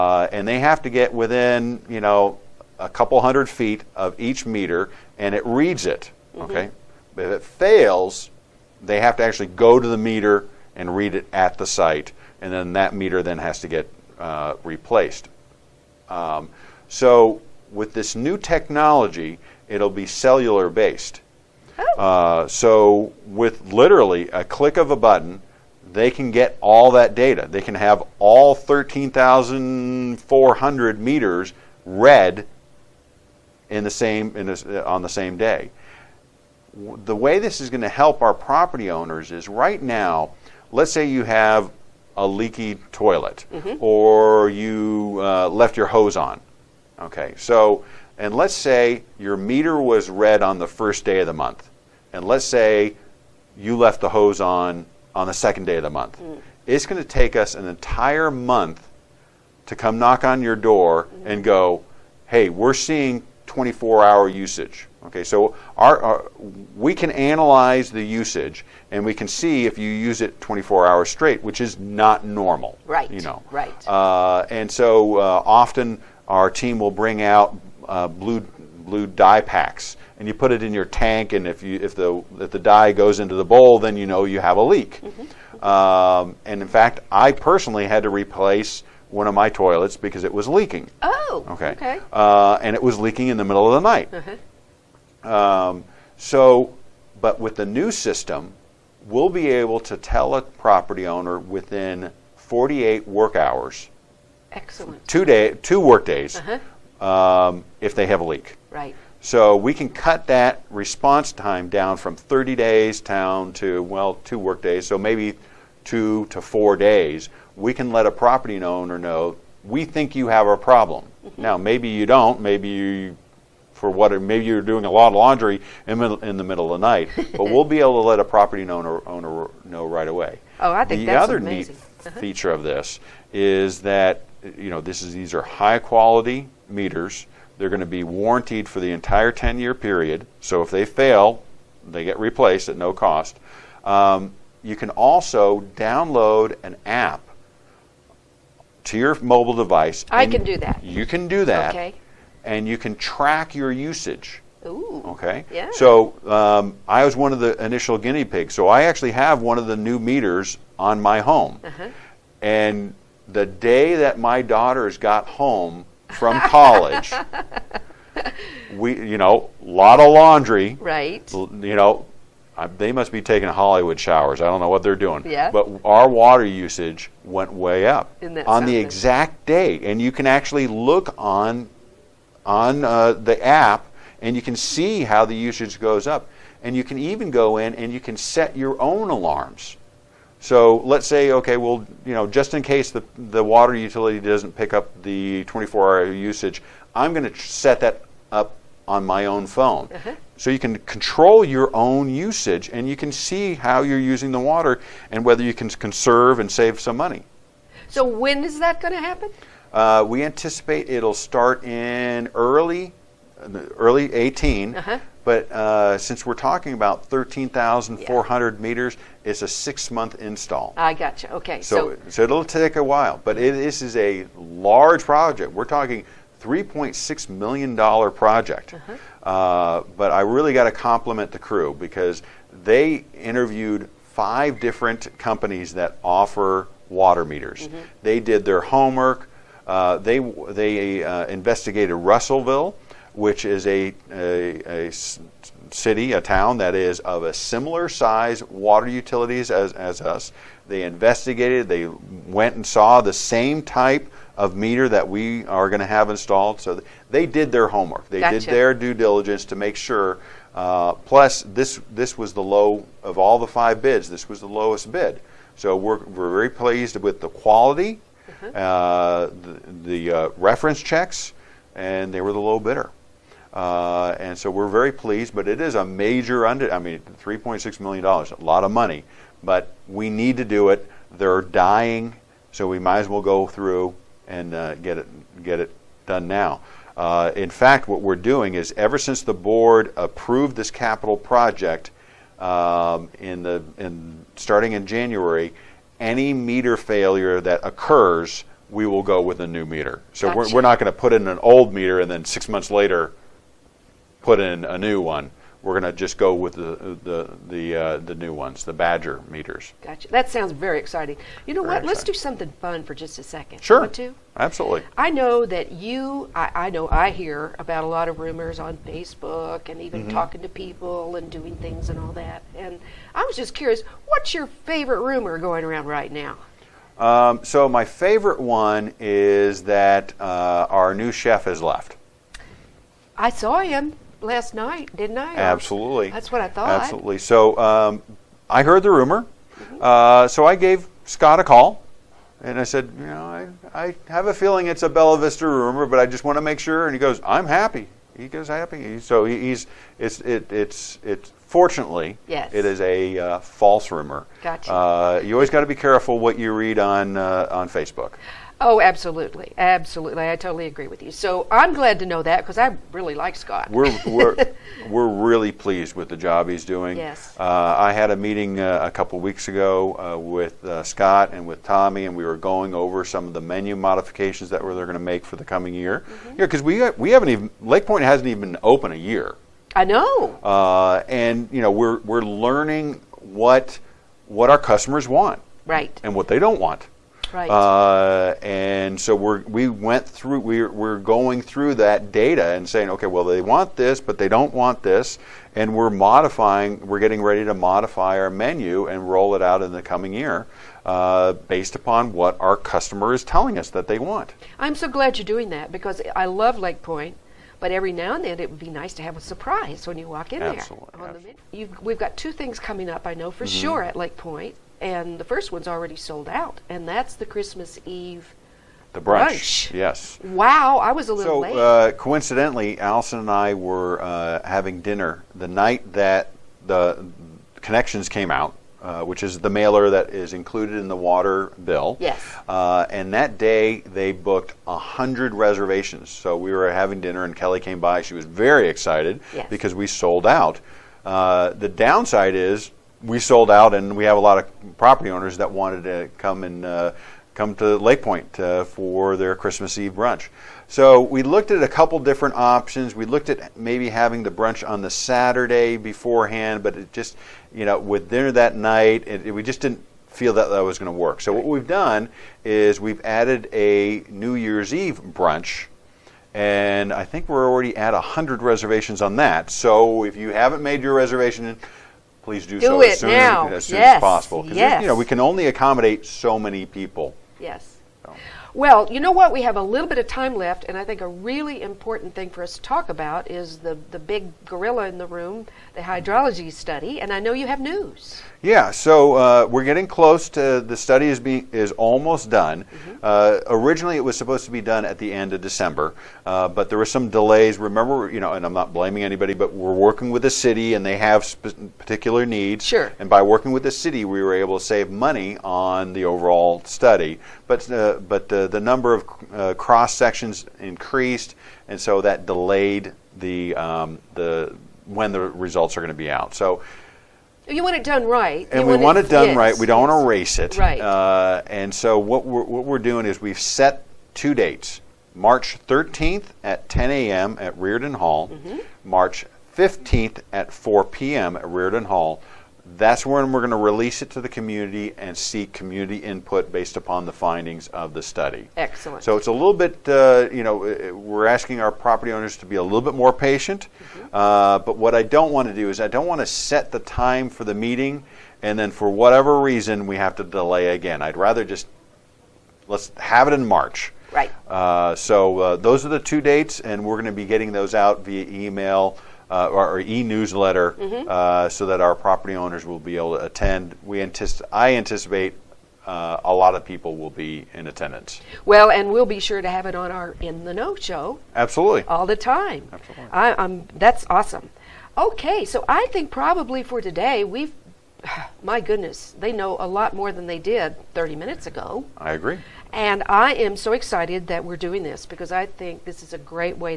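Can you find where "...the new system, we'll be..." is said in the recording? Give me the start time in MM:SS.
01:37.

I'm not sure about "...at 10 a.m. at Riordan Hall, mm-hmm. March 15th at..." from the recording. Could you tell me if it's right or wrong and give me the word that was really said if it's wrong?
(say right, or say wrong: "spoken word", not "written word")
right.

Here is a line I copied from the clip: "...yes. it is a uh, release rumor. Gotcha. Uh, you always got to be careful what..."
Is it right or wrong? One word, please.
wrong.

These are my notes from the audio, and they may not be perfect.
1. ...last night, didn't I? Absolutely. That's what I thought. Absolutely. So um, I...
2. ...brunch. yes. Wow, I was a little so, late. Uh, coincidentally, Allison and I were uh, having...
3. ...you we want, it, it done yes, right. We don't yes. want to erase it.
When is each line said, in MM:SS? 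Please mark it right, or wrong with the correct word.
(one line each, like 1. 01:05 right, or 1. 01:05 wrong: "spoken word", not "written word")
1. 05:34 right
2. 06:59 right
3. 08:38 right.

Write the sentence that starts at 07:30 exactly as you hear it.
So we looked at a couple different options.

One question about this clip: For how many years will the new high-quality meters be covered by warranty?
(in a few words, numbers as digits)
10.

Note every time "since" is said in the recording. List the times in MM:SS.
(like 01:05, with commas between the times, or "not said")
03:35, 04:48.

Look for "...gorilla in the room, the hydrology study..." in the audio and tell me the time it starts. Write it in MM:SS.
08:04.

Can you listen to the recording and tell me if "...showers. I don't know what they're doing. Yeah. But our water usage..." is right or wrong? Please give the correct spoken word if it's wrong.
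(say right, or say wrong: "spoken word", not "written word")
right.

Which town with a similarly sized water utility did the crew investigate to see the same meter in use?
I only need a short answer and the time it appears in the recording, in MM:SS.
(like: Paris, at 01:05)
Russellville, at 04:01.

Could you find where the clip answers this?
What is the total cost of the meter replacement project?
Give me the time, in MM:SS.
03:46.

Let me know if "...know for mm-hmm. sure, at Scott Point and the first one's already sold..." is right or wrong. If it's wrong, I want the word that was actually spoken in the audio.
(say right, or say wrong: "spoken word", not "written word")
wrong: "Lake", not "Scott".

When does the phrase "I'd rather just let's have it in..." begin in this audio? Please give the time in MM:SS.
09:11.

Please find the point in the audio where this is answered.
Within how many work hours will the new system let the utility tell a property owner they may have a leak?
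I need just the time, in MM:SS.
01:42.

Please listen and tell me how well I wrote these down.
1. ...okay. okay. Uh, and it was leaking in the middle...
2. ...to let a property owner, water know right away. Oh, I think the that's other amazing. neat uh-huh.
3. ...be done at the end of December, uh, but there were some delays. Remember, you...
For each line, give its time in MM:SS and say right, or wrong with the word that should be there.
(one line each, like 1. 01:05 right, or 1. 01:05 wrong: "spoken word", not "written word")
1. 01:31 right
2. 02:08 wrong: "owner", not "water"
3. 08:14 right.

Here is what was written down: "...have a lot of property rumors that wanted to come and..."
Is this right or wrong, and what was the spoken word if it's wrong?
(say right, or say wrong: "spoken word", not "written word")
wrong: "owners", not "rumors".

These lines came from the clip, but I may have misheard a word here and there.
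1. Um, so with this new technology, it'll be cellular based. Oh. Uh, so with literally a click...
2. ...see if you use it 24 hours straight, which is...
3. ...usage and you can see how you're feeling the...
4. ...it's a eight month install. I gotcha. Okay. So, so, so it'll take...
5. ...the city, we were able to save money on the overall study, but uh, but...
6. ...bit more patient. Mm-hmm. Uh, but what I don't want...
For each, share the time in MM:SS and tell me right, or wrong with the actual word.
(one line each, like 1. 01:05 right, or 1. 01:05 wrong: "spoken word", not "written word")
1. 00:16 right
2. 01:09 right
3. 03:22 wrong: "using", not "feeling"
4. 03:39 wrong: "six", not "eight"
5. 08:23 right
6. 09:02 right.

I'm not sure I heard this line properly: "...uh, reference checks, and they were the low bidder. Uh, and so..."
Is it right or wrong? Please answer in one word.
right.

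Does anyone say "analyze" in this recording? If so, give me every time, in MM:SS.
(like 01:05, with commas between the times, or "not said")
01:07.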